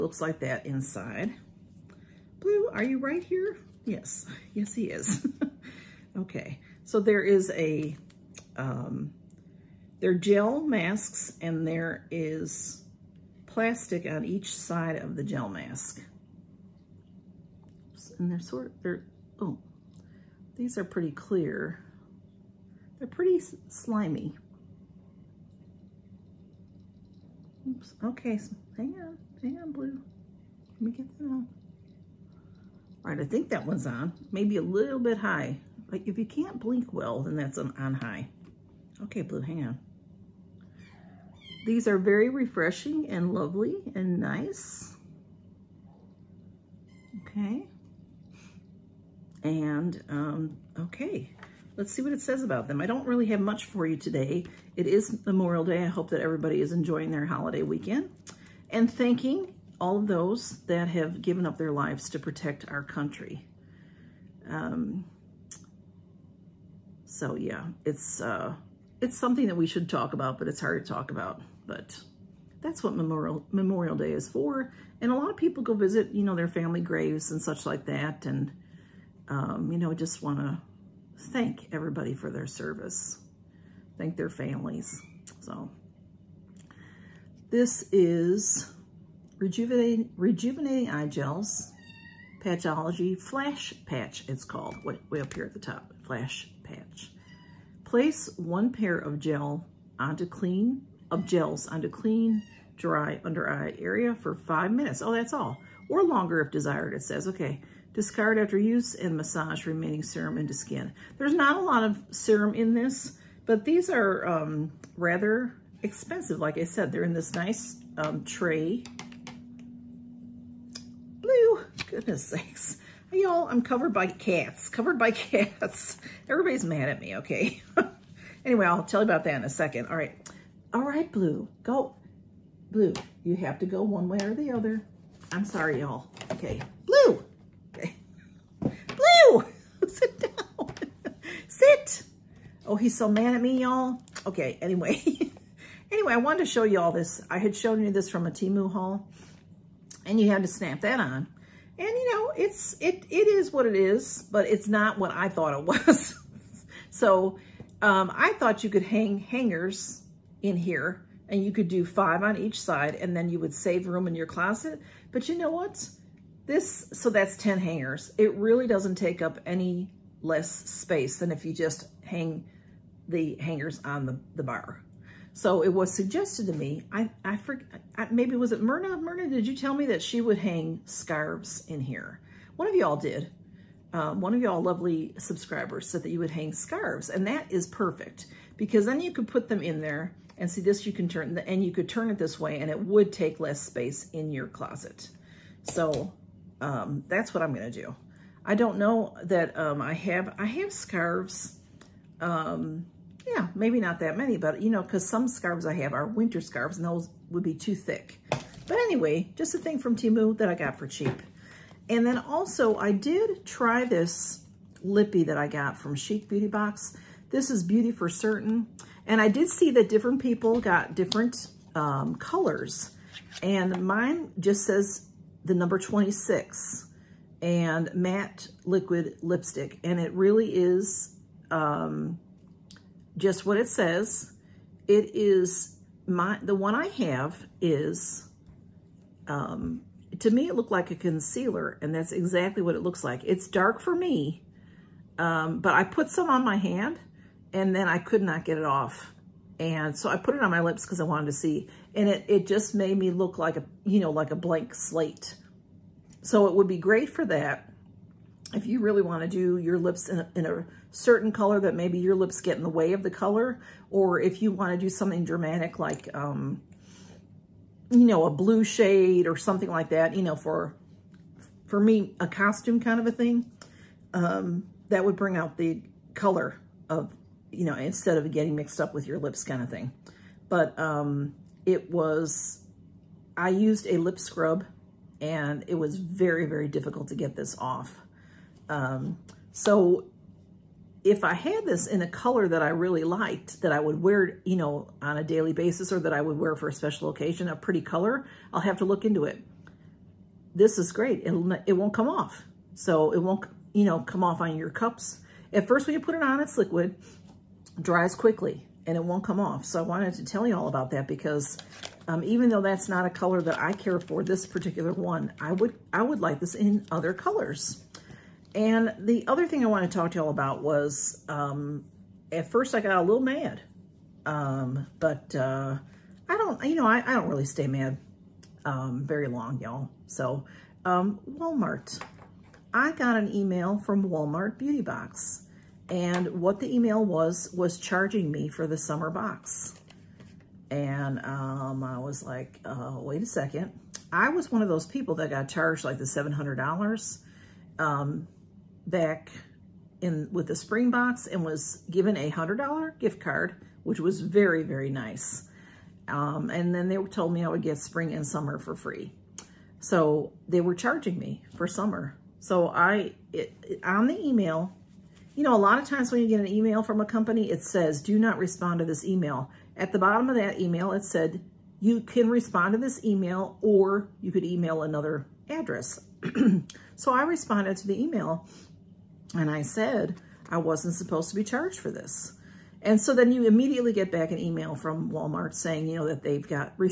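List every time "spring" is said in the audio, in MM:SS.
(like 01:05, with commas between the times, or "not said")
05:50, 05:57.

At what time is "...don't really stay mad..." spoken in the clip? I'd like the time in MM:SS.
05:27.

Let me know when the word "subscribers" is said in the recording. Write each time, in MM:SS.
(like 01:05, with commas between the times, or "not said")
03:05.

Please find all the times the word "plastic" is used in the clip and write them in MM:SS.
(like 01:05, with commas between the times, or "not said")
00:13.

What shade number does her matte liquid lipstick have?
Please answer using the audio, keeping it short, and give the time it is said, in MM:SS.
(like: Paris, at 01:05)
26, at 03:45.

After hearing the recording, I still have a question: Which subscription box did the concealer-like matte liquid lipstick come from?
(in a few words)
Chic Beauty Box.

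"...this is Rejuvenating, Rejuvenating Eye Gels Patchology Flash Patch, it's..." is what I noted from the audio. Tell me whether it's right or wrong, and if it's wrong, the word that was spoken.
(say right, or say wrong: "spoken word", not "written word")
right.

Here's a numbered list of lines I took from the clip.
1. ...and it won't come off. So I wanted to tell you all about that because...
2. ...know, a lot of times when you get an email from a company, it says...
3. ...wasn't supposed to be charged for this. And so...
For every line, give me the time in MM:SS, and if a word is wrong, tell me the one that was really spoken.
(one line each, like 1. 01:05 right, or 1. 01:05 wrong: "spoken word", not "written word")
1. 05:08 right
2. 06:05 right
3. 06:20 right.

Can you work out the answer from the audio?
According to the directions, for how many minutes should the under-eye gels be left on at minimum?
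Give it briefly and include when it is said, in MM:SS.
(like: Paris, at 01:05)
5 minutes, at 01:44.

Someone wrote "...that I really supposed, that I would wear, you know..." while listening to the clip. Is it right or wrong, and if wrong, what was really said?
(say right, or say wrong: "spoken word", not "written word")
wrong: "liked", not "supposed".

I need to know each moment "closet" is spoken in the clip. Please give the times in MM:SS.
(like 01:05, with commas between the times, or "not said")
02:44, 03:14.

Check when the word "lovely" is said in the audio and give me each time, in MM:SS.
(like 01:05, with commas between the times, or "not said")
00:43, 03:04.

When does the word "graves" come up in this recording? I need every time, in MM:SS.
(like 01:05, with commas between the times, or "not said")
01:16.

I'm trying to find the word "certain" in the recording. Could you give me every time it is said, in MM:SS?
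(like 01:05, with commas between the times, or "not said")
03:38, 04:20.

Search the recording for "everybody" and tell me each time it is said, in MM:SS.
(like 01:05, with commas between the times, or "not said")
00:56, 01:21, 02:06.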